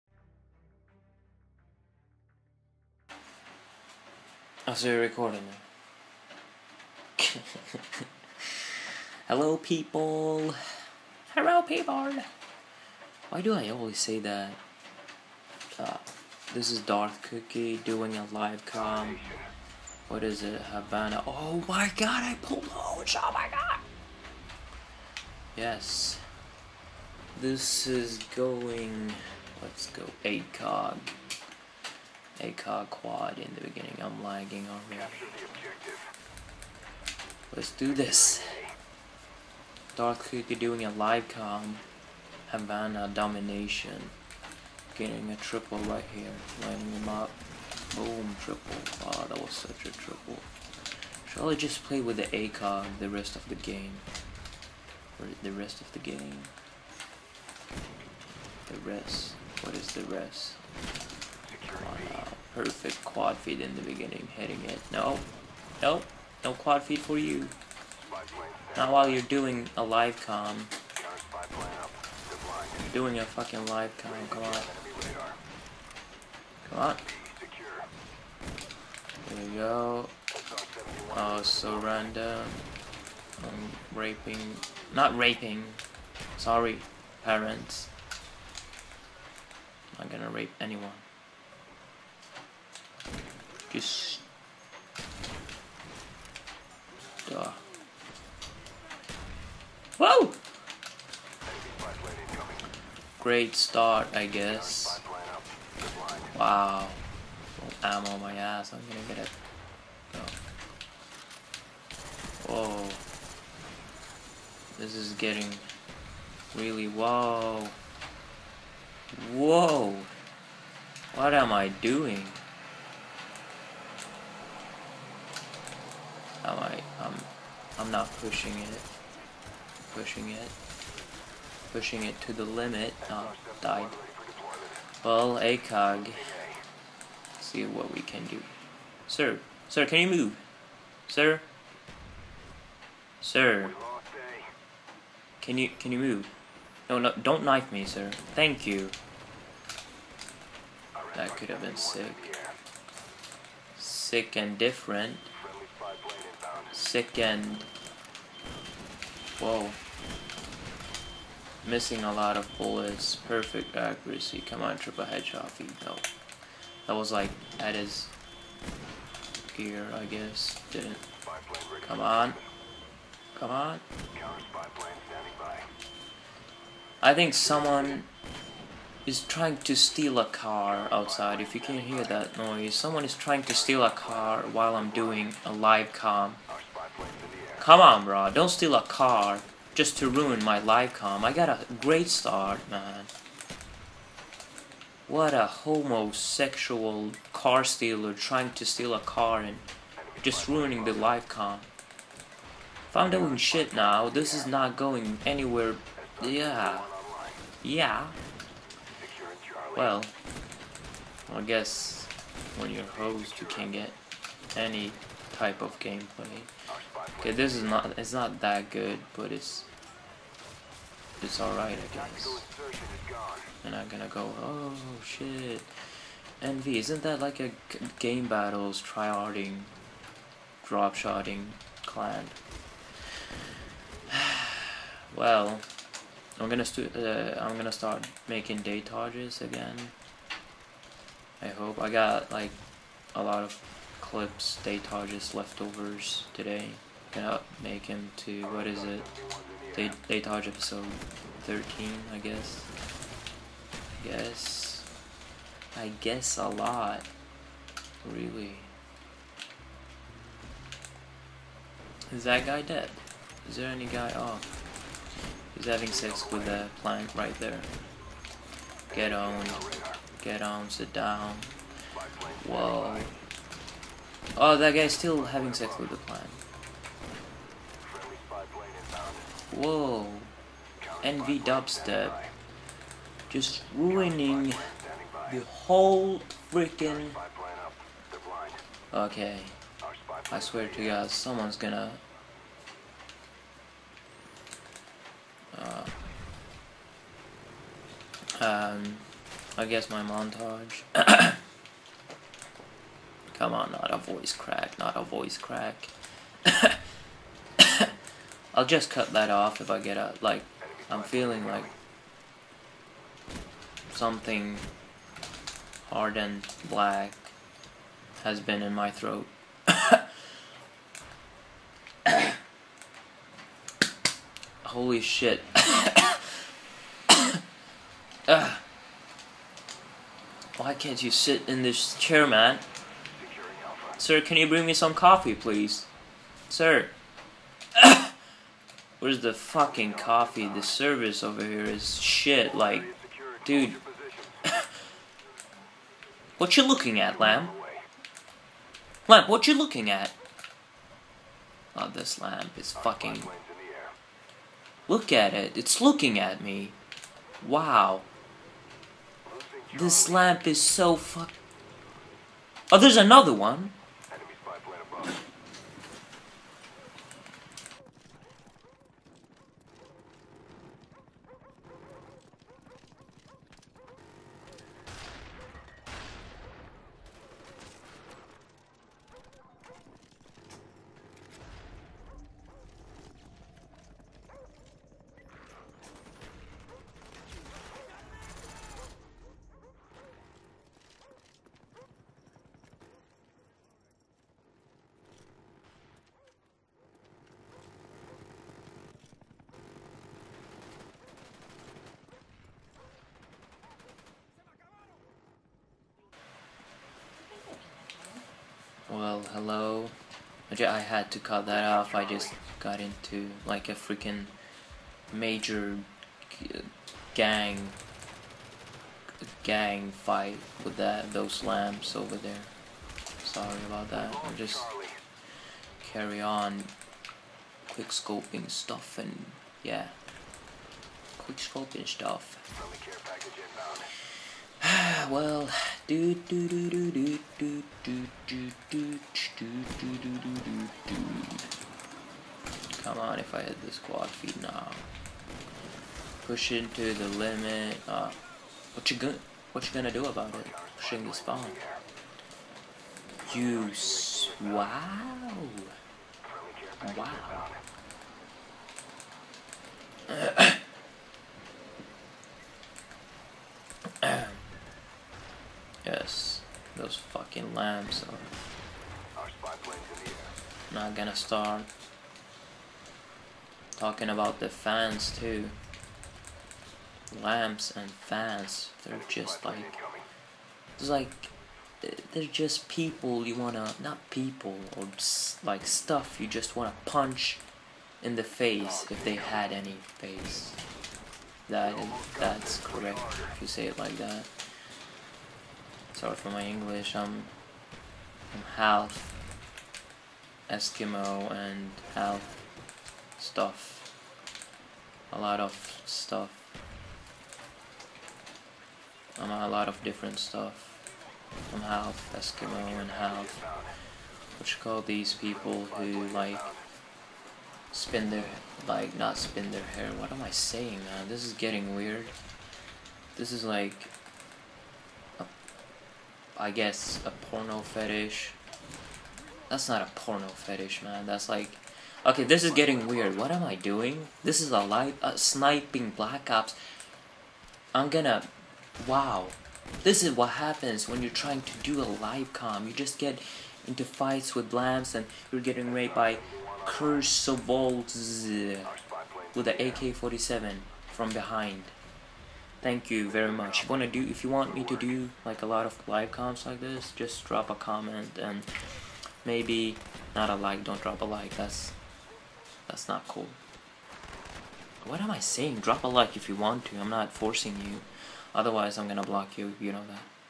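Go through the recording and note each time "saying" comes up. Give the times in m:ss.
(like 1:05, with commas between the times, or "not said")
8:40, 9:25.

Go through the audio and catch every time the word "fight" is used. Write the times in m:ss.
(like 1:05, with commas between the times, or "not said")
6:59, 9:03.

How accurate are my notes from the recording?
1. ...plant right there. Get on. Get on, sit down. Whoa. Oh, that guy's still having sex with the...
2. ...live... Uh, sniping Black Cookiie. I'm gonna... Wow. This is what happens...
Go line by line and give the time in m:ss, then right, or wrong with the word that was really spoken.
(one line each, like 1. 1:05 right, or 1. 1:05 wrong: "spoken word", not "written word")
1. 4:26 right
2. 8:54 wrong: "Ops", not "Cookiie".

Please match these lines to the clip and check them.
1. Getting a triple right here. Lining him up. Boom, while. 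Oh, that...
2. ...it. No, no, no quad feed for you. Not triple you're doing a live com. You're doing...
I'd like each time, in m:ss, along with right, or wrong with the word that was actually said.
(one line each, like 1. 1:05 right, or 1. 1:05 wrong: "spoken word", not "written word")
1. 0:44 wrong: "triple", not "while"
2. 1:04 wrong: "while", not "triple".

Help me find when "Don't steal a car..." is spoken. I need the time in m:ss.
3:08.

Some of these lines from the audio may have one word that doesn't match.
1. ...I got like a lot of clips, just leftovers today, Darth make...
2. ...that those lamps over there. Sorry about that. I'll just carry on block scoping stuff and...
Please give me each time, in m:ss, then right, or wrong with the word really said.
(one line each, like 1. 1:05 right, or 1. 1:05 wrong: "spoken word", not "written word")
1. 4:01 wrong: "Gonna", not "Darth"
2. 7:00 wrong: "quick", not "block".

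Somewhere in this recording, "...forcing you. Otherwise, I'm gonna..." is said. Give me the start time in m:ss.
9:27.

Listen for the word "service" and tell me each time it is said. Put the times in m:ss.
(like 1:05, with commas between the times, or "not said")
5:40.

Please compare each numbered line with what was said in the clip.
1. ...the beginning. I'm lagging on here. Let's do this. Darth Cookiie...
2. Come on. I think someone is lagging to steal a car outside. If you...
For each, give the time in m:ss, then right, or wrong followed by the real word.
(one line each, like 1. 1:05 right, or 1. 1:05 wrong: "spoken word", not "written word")
1. 0:33 right
2. 2:53 wrong: "trying", not "lagging".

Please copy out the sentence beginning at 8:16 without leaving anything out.
Sorry for my English, I'm, I'm half Eskimo and half stuff.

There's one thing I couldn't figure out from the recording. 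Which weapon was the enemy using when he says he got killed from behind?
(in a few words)
AK-47.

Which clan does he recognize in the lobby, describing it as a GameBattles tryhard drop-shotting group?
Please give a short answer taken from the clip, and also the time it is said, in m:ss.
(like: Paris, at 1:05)
Envy, at 3:46.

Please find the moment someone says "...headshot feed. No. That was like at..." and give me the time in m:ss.
2:45.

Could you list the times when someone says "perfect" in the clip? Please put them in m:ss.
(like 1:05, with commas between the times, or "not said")
1:02, 2:43.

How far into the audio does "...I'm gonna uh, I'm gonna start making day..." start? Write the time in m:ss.
3:56.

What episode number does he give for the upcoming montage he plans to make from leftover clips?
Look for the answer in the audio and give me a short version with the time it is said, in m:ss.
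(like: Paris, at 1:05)
13, at 4:11.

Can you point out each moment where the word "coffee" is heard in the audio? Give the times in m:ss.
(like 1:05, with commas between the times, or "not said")
5:34, 5:39.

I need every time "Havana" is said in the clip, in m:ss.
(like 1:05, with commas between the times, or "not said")
0:20, 0:42.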